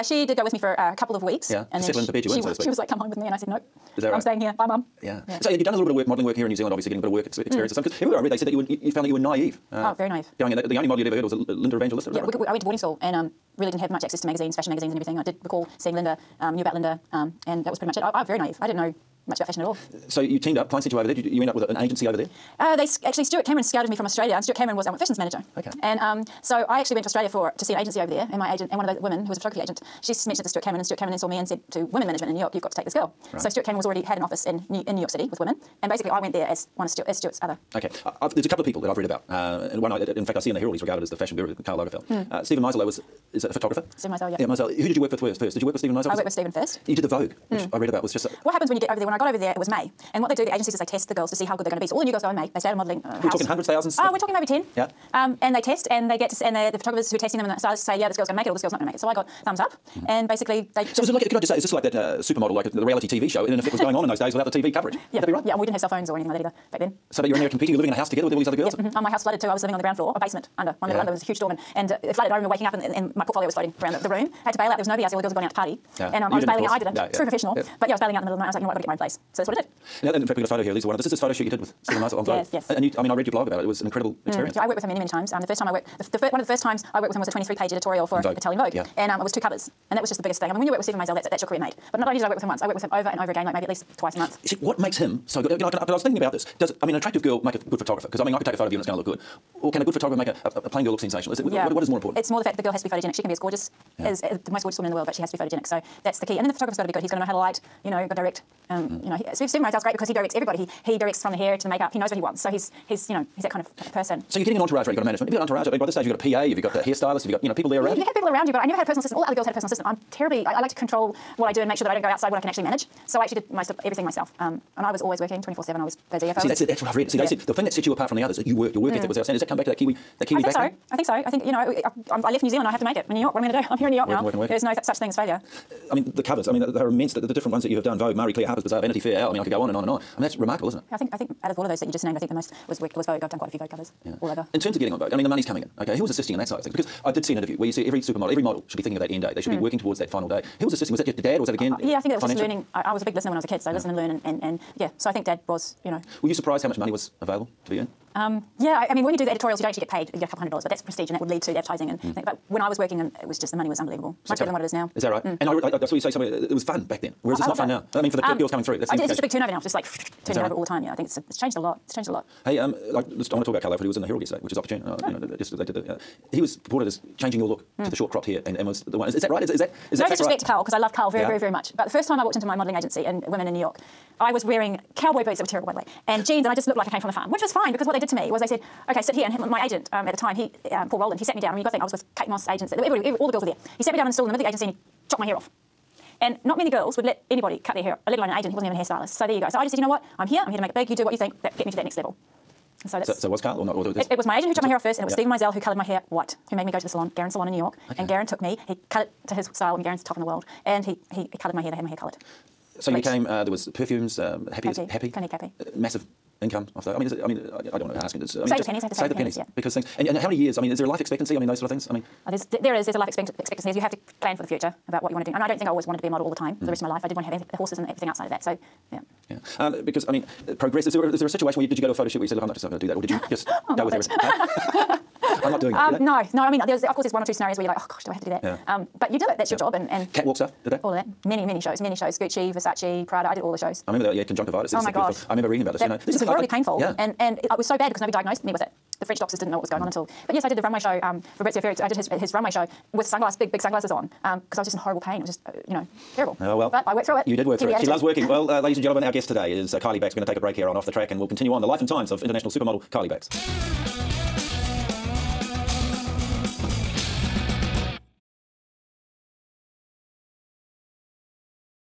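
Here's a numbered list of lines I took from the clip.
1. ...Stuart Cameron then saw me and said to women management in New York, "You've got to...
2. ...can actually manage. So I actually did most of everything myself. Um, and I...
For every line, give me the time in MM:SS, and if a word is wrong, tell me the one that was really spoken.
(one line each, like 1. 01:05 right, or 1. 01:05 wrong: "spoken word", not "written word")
1. 00:30 right
2. 02:02 right.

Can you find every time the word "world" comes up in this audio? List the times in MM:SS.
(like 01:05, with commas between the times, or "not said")
01:44, 03:30.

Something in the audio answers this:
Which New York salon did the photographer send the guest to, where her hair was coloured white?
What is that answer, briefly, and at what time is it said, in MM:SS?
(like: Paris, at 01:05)
Garren Salon, at 03:27.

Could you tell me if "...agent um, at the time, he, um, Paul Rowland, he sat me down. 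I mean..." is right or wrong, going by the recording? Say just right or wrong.
right.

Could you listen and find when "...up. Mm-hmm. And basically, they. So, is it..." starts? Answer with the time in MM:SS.
00:59.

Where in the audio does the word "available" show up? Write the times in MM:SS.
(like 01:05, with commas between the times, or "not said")
02:37.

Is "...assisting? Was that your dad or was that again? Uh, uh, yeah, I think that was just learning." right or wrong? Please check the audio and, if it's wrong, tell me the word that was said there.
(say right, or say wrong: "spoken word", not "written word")
right.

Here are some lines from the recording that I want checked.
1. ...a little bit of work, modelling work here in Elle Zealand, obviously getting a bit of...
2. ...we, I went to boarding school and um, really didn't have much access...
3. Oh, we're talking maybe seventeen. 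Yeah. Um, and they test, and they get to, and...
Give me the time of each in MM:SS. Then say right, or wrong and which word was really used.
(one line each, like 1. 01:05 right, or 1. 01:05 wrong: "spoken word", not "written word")
1. 00:05 wrong: "New", not "Elle"
2. 00:12 right
3. 00:53 wrong: "ten", not "seventeen".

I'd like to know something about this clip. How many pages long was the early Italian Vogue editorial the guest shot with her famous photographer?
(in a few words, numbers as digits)
23.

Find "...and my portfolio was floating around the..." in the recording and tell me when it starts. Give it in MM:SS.
01:12.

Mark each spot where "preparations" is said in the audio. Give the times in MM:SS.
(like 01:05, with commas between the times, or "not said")
not said.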